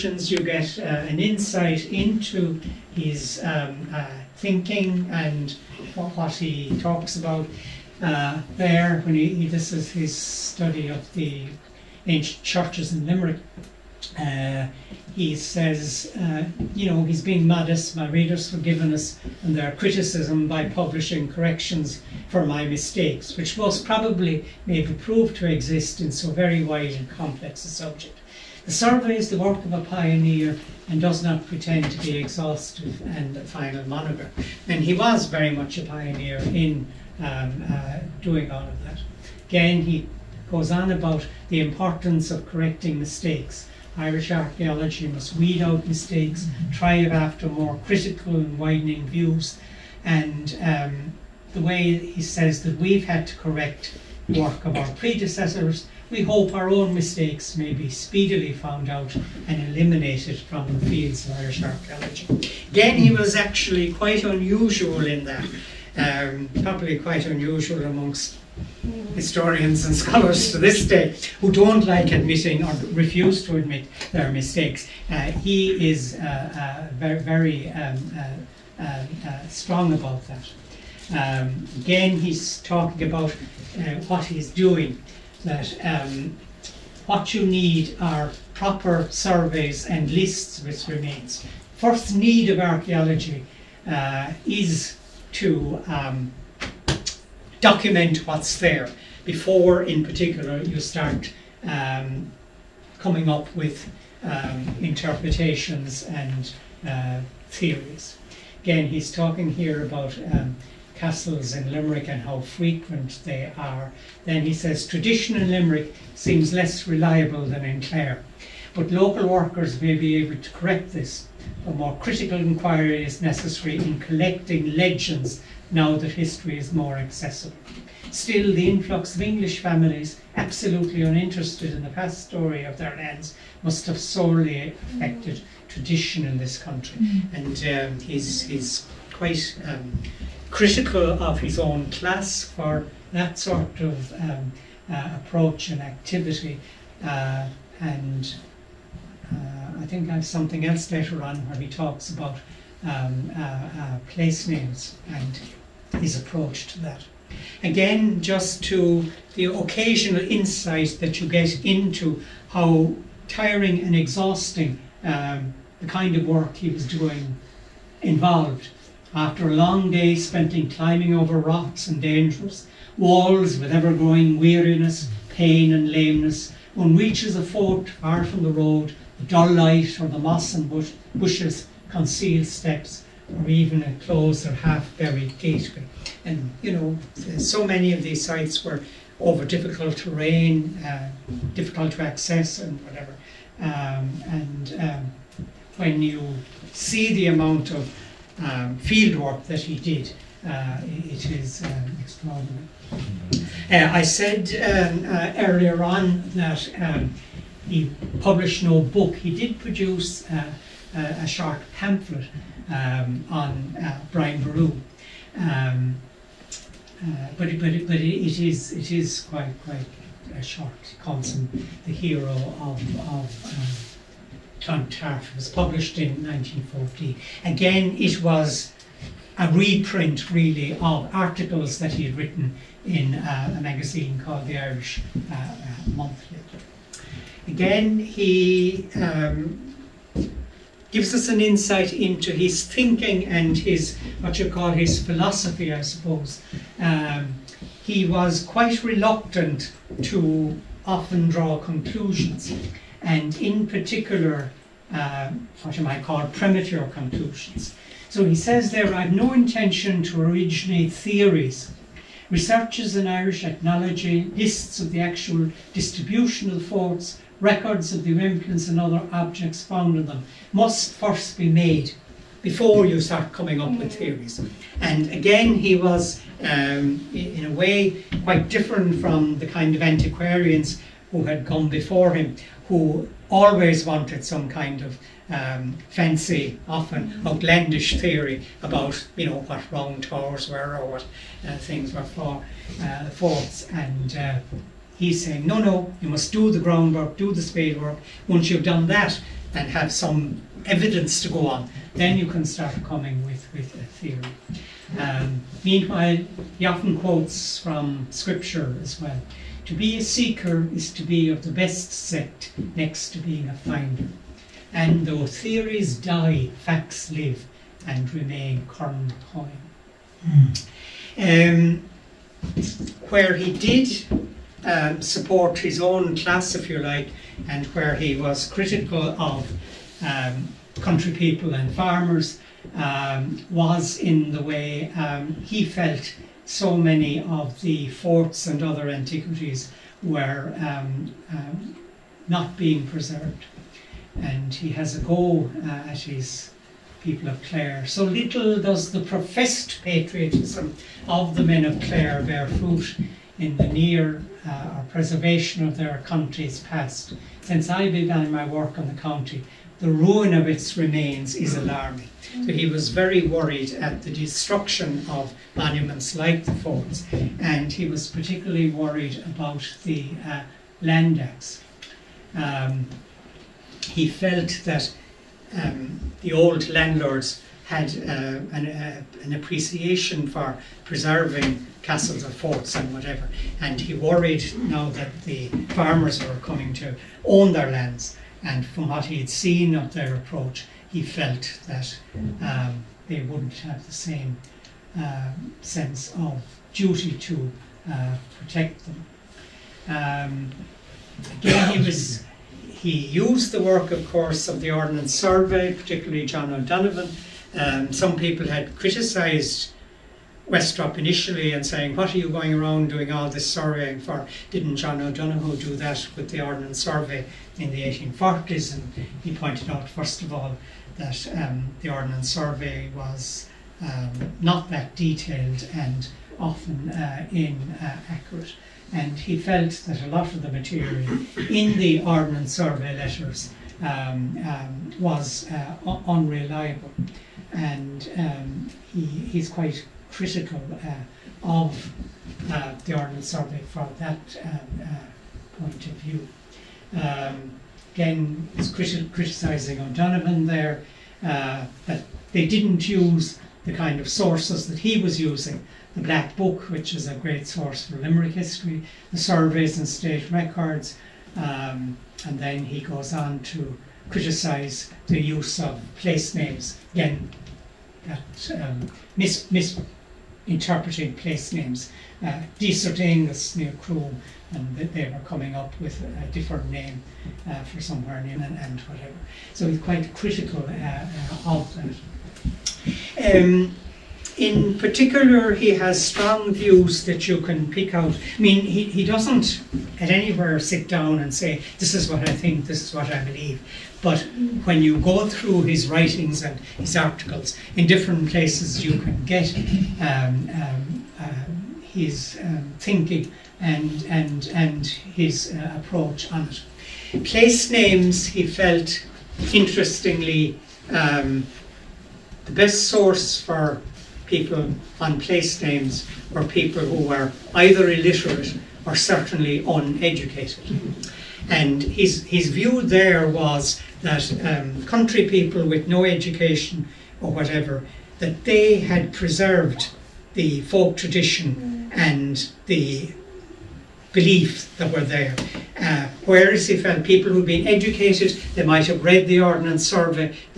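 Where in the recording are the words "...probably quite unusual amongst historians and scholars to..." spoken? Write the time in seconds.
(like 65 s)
66 s.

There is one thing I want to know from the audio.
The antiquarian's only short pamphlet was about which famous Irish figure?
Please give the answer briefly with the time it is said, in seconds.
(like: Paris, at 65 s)
Brian Boru, at 214 s.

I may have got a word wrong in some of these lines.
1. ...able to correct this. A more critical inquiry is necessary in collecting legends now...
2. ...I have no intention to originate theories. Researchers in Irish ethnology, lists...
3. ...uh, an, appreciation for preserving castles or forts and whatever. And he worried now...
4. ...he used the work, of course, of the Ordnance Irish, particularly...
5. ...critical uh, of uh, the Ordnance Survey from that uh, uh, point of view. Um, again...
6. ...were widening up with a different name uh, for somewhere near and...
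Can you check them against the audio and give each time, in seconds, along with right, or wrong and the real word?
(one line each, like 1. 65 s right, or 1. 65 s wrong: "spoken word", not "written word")
1. 120 s right
2. 258 s right
3. 378 s right
4. 402 s wrong: "Survey", not "Irish"
5. 440 s right
6. 475 s wrong: "coming", not "widening".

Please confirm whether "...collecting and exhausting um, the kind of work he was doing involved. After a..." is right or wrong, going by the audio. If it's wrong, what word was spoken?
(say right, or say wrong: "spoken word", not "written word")
wrong: "tiring", not "collecting".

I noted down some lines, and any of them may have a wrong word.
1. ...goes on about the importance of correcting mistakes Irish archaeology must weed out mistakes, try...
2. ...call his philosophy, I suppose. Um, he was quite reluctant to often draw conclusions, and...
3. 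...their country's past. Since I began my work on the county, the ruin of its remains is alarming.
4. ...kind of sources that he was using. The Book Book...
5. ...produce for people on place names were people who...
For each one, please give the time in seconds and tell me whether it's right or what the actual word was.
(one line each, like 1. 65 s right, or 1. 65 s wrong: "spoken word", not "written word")
1. 40 s right
2. 244 s right
3. 355 s right
4. 453 s wrong: "Black", not "Book"
5. 512 s wrong: "source", not "produce".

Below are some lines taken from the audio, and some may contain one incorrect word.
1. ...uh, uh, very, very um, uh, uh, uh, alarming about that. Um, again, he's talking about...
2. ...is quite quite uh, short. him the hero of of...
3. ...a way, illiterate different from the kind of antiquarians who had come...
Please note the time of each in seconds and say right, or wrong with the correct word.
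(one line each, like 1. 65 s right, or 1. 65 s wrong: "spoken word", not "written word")
1. 76 s wrong: "strong", not "alarming"
2. 218 s right
3. 277 s wrong: "quite", not "illiterate".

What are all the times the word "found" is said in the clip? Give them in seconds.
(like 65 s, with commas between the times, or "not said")
58 s, 269 s.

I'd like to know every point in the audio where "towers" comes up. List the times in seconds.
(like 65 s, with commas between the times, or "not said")
290 s.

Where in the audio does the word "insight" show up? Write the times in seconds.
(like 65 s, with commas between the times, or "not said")
1 s, 160 s, 241 s.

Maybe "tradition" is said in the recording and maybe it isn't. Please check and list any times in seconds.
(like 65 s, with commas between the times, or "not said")
114 s, 135 s, 530 s.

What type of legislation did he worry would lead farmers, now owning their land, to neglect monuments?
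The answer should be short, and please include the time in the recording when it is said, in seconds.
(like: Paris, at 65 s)
Land Acts, at 370 s.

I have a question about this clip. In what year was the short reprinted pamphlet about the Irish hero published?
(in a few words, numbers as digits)
1940.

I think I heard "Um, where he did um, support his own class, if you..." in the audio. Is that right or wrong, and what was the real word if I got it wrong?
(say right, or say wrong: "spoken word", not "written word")
right.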